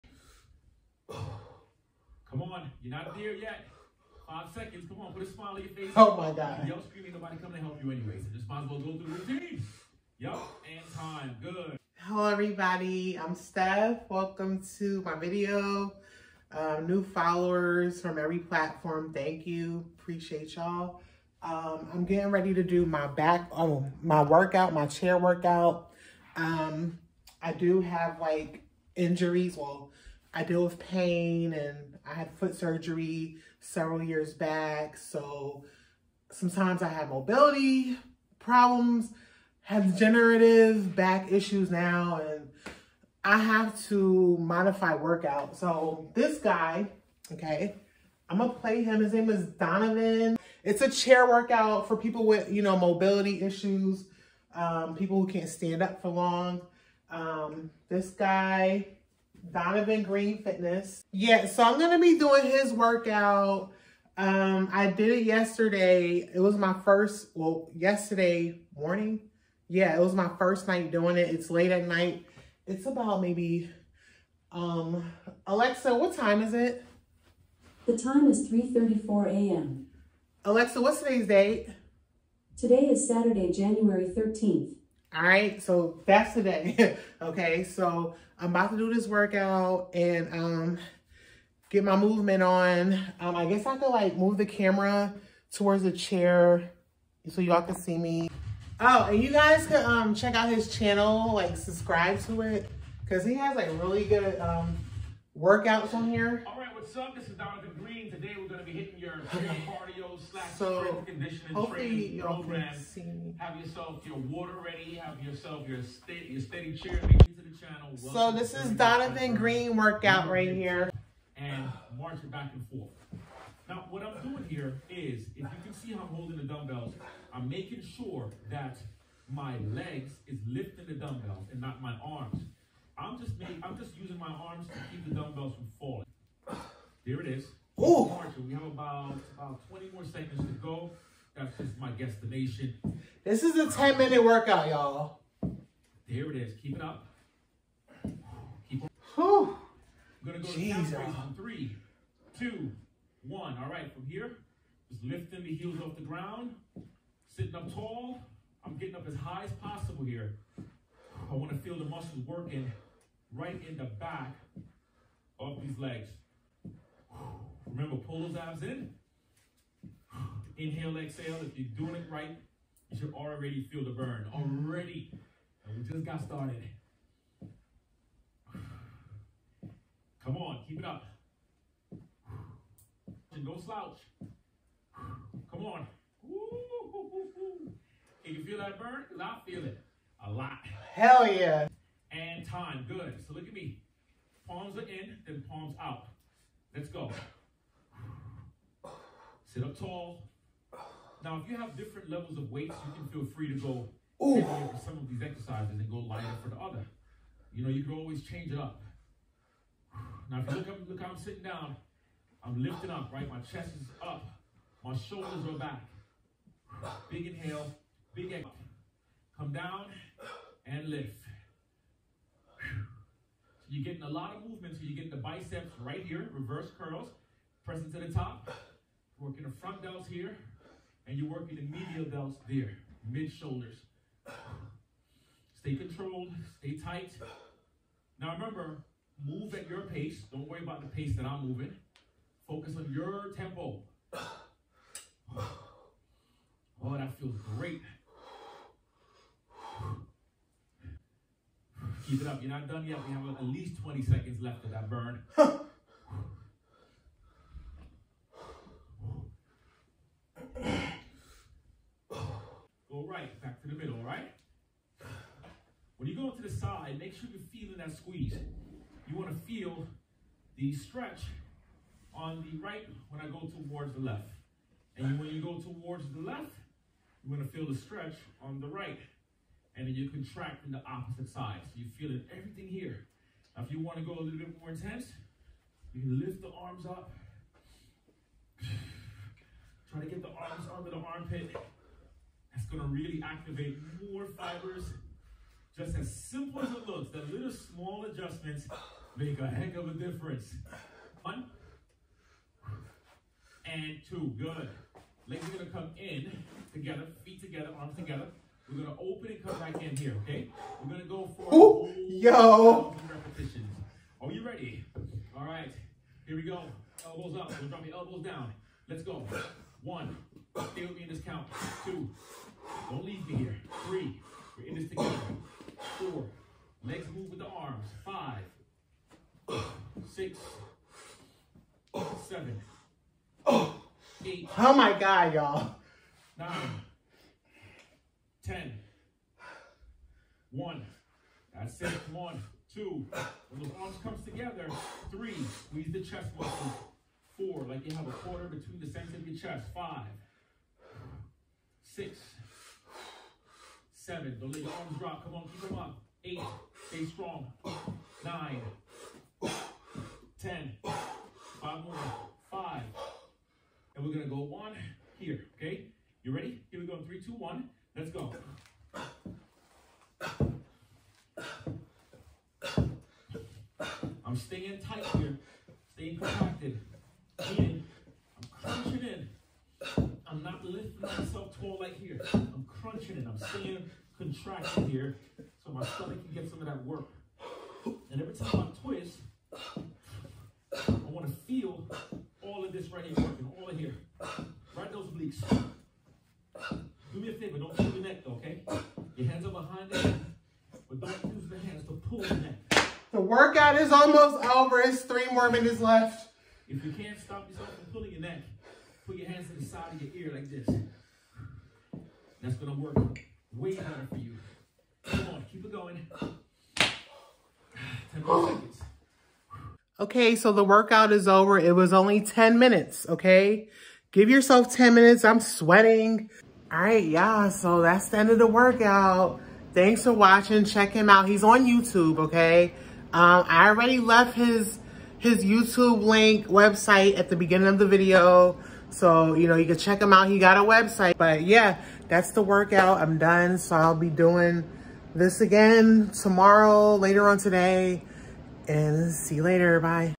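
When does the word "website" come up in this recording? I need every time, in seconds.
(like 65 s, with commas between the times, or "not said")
436 s, 440 s.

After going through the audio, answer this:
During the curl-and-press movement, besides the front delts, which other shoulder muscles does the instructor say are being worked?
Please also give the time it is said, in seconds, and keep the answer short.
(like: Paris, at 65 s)
medial delts, at 231 s.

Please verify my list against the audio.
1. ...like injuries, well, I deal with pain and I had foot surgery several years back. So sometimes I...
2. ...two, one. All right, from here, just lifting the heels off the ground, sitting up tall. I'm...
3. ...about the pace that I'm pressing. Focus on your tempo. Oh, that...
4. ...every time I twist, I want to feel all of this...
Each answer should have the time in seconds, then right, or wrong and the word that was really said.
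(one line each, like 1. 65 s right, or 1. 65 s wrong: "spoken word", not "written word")
1. 28 s right
2. 152 s right
3. 240 s wrong: "moving", not "pressing"
4. 388 s right.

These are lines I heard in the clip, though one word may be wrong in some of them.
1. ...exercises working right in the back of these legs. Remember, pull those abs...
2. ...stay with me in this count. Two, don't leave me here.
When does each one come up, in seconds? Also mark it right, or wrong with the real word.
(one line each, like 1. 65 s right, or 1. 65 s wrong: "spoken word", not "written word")
1. 161 s wrong: "muscles", not "exercises"
2. 320 s right.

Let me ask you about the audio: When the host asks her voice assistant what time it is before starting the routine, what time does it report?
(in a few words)
3:34 a.m.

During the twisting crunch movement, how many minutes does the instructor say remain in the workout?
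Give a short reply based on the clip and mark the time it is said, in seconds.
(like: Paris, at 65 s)
3, at 405 s.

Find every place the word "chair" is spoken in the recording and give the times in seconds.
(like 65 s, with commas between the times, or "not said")
24 s, 50 s, 95 s.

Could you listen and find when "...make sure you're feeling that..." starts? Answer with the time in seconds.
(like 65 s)
266 s.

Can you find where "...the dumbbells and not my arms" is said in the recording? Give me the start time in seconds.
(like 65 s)
130 s.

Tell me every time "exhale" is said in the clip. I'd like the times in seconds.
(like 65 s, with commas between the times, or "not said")
170 s, 218 s.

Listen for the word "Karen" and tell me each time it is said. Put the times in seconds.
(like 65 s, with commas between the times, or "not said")
not said.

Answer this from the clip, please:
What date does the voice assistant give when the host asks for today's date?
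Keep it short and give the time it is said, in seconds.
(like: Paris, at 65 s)
Saturday, January 13th, at 83 s.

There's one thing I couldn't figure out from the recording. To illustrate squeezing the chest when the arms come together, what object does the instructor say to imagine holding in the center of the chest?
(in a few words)
a quarter.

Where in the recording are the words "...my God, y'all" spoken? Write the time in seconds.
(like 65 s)
334 s.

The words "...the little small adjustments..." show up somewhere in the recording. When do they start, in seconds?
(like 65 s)
297 s.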